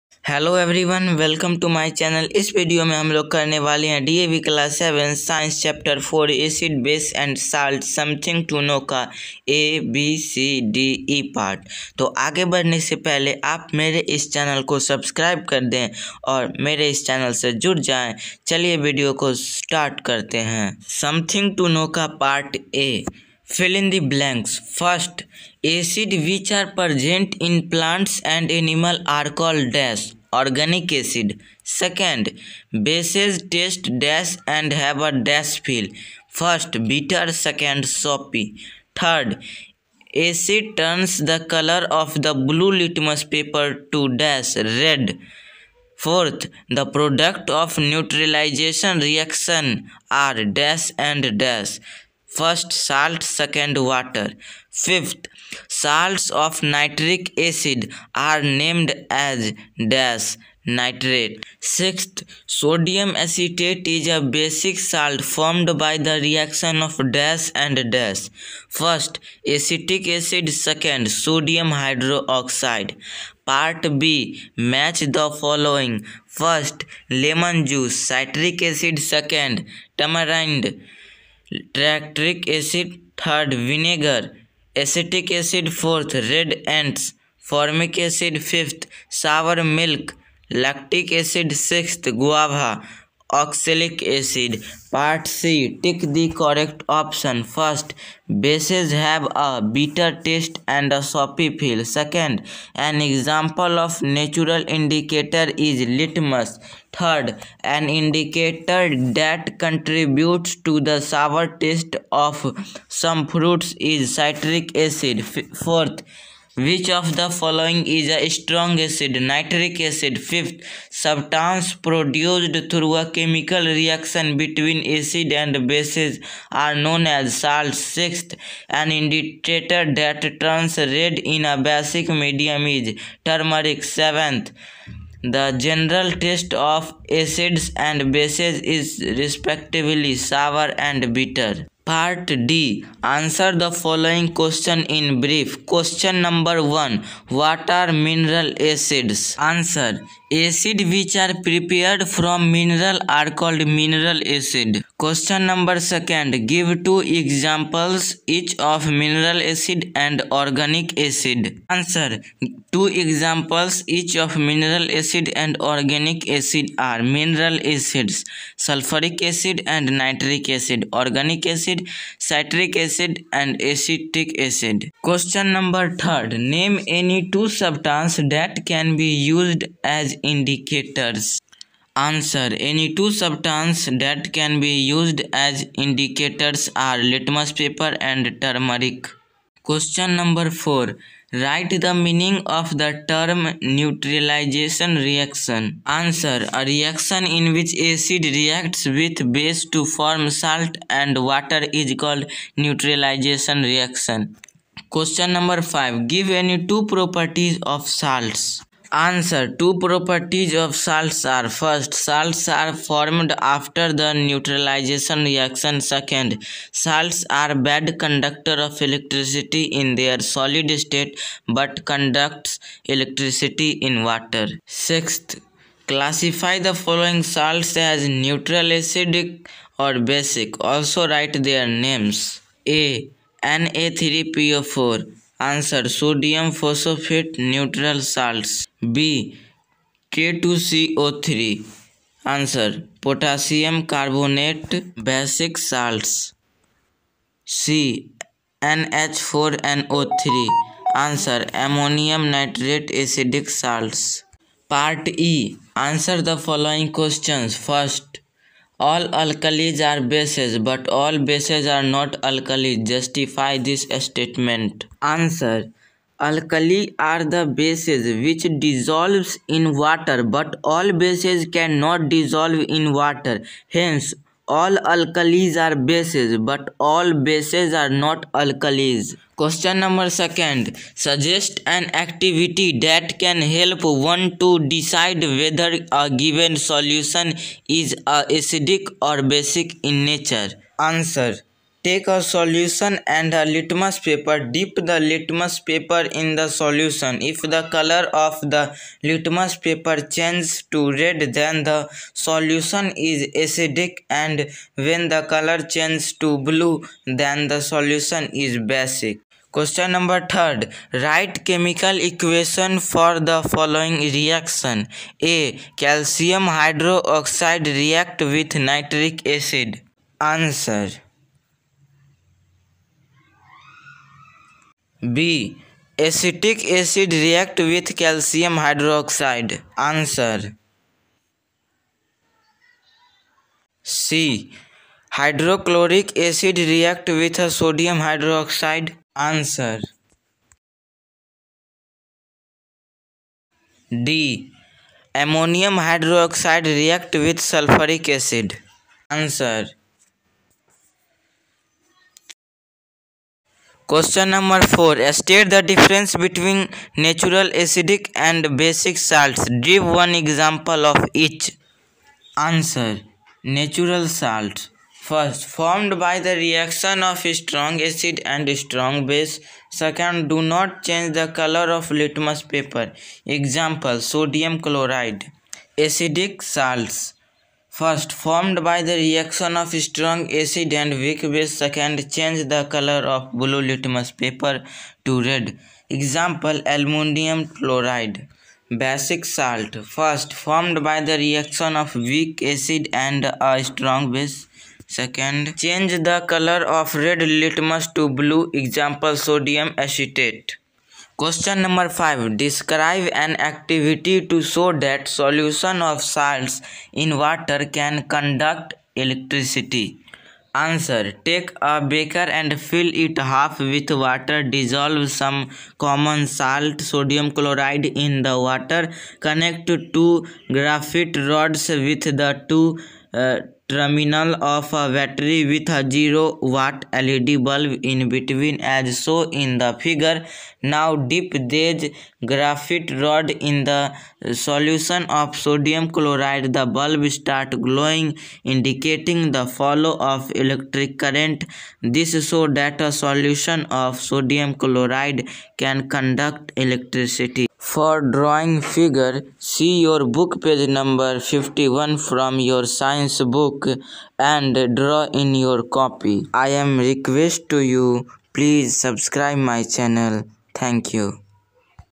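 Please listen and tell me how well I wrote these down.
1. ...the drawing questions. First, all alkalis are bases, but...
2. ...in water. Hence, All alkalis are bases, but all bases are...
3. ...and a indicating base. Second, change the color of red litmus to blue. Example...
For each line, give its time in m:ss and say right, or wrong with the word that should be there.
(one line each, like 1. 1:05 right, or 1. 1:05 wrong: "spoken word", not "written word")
1. 4:16 wrong: "following", not "drawing"
2. 4:32 right
3. 6:33 wrong: "strong", not "indicating".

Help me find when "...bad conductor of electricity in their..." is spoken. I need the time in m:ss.
3:37.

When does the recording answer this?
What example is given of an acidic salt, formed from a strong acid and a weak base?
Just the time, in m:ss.
6:26.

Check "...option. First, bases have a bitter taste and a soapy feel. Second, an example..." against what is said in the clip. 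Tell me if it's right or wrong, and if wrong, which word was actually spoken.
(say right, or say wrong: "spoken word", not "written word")
right.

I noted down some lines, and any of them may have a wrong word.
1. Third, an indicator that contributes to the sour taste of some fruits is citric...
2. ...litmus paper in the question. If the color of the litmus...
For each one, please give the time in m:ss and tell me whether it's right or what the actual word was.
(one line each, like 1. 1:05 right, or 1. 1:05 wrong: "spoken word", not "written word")
1. 1:46 right
2. 4:54 wrong: "solution", not "question".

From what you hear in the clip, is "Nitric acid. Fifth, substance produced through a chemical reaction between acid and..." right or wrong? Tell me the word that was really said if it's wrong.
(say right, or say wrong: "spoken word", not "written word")
right.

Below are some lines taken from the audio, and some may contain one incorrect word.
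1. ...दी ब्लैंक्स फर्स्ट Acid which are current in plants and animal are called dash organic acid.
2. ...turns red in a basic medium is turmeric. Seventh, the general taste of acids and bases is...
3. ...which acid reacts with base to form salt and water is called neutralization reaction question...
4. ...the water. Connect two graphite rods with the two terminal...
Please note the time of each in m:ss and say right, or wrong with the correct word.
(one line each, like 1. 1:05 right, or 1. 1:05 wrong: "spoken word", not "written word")
1. 0:23 wrong: "present", not "current"
2. 2:10 right
3. 3:17 right
4. 6:58 right.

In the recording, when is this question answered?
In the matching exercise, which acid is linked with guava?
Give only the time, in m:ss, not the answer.
1:33.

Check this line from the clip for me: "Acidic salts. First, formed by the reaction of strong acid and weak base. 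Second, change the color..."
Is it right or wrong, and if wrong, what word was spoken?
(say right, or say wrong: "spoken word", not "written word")
right.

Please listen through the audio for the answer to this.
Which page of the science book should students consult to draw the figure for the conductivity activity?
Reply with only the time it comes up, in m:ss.
7:31.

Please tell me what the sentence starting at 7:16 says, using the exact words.
The bulb start glowing indicating the flow of electric current.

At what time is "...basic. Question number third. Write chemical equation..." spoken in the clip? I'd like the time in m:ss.
5:08.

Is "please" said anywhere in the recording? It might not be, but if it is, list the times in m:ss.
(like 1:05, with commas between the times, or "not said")
7:38.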